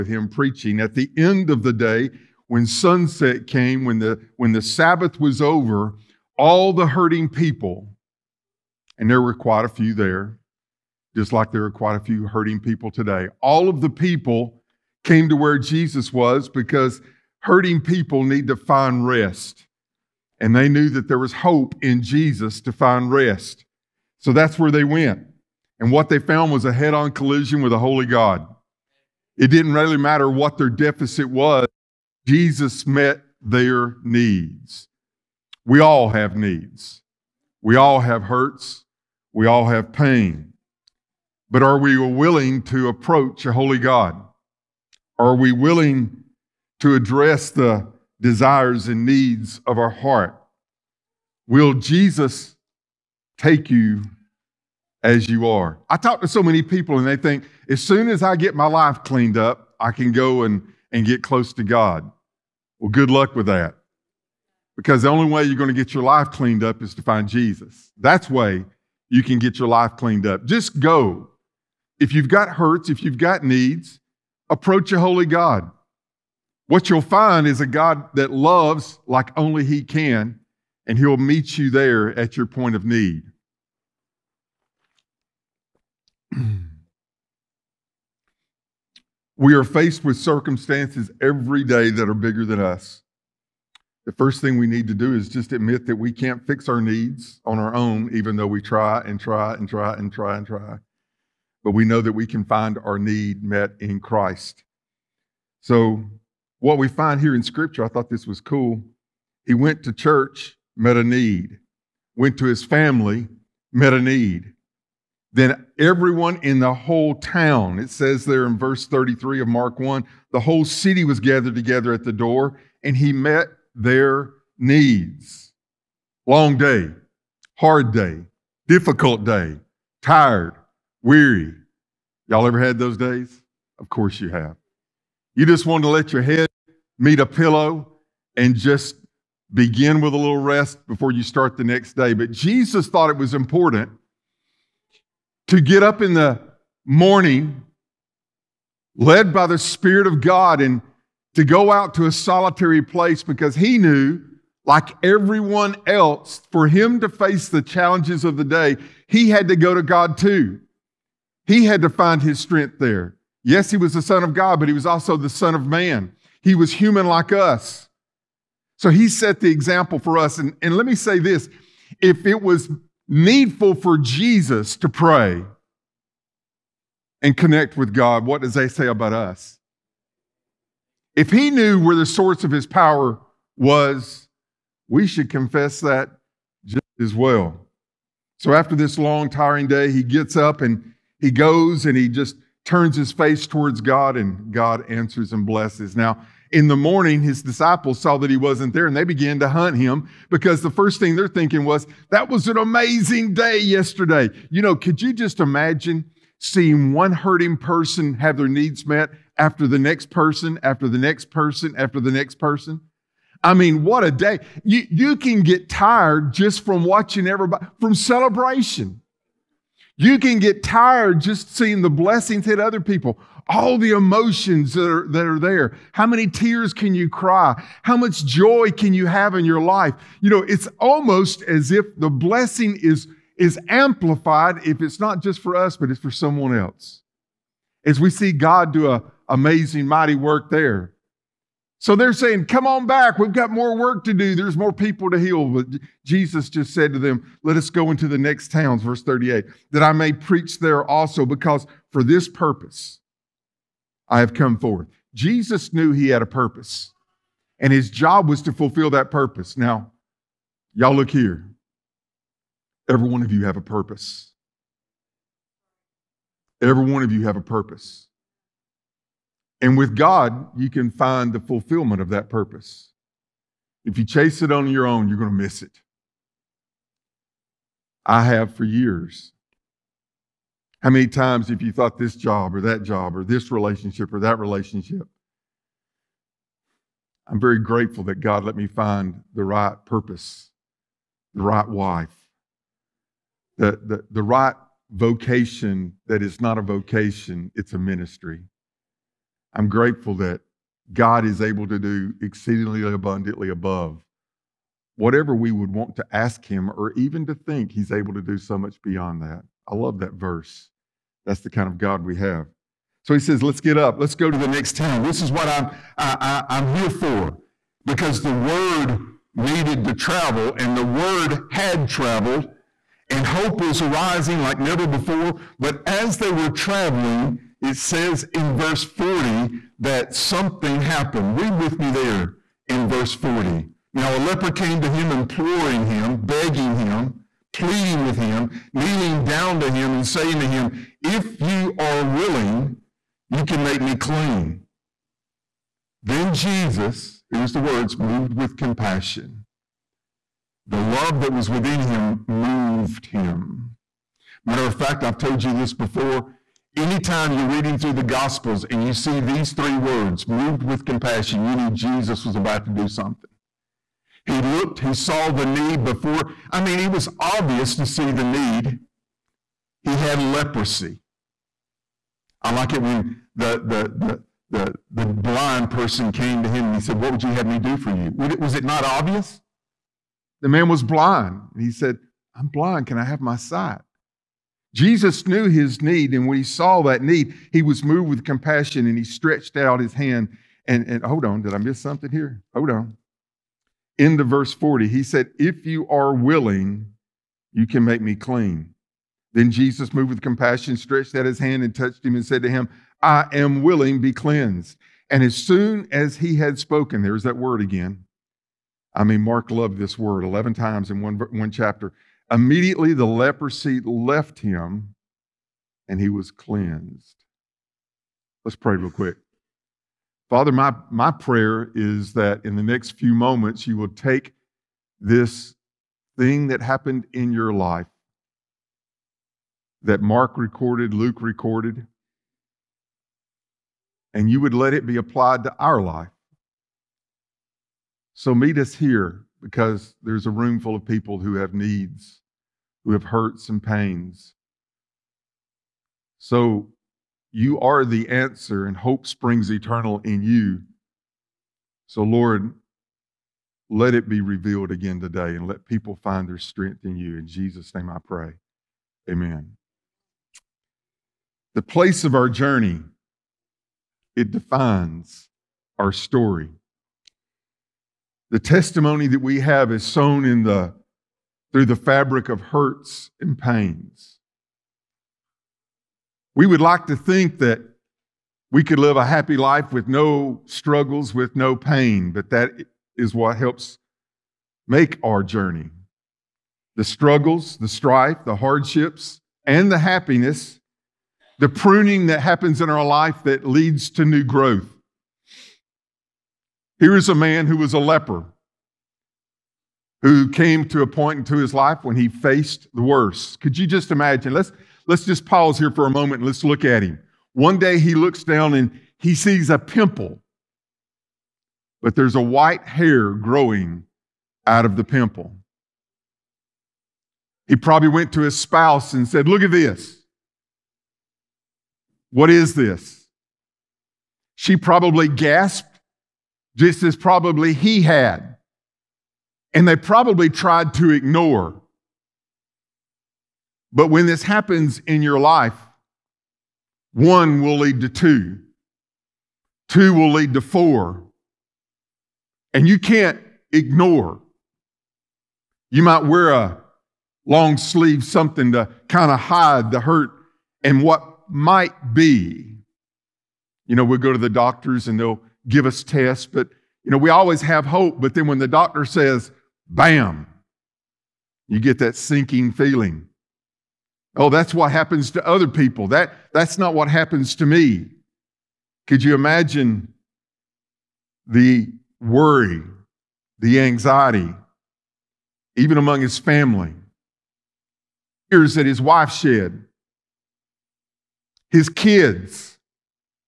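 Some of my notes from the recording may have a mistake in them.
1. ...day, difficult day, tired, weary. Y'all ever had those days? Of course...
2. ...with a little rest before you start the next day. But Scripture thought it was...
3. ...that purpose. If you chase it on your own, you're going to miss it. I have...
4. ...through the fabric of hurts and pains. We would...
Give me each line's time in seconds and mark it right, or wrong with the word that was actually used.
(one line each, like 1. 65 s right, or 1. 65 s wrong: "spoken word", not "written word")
1. 127 s right
2. 139 s wrong: "Jesus", not "Scripture"
3. 272 s right
4. 471 s right.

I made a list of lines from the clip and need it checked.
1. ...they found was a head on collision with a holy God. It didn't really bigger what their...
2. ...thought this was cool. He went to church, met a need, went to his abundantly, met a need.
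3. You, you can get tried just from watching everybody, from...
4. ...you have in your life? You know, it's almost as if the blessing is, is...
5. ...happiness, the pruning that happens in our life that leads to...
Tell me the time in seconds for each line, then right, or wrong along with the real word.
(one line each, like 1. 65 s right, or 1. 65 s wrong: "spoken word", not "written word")
1. 26 s wrong: "matter", not "bigger"
2. 107 s wrong: "family", not "abundantly"
3. 214 s wrong: "tired", not "tried"
4. 228 s right
5. 489 s right.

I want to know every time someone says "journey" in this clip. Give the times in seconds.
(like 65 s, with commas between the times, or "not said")
462 s, 485 s.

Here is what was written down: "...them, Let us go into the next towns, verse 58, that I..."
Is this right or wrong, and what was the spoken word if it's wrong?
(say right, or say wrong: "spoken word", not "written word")
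wrong: "38", not "58".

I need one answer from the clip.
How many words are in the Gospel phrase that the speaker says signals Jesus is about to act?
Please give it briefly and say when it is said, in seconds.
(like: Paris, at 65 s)
3, at 359 s.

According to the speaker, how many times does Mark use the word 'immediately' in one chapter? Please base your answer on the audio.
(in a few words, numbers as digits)
11.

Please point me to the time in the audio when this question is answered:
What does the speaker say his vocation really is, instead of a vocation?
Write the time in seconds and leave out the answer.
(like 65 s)
297 s.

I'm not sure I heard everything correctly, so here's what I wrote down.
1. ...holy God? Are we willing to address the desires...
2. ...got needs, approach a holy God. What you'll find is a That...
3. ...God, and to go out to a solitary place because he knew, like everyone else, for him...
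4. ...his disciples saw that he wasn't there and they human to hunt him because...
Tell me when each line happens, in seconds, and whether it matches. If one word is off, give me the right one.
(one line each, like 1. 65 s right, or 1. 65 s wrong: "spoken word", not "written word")
1. 43 s right
2. 73 s wrong: "God", not "That"
3. 150 s right
4. 197 s wrong: "began", not "human".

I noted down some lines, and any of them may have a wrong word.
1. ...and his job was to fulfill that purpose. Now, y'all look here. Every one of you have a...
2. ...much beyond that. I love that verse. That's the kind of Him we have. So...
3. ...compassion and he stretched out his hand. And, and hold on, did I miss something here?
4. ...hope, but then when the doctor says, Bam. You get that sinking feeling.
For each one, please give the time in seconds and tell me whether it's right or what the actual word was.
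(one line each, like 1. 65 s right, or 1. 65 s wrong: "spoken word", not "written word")
1. 257 s right
2. 308 s wrong: "God", not "Him"
3. 388 s right
4. 557 s right.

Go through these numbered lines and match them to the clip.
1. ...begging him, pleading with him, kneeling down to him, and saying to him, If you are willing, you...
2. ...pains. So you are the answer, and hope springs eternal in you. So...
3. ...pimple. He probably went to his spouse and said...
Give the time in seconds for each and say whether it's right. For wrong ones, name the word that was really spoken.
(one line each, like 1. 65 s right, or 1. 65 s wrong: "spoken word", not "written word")
1. 336 s right
2. 443 s right
3. 514 s right.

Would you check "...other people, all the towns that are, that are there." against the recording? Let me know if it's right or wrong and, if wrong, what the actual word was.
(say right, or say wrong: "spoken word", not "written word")
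wrong: "emotions", not "towns".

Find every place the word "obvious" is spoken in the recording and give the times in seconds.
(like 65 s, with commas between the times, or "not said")
367 s, 378 s.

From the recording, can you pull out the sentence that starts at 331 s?
Read with me there in verse 40.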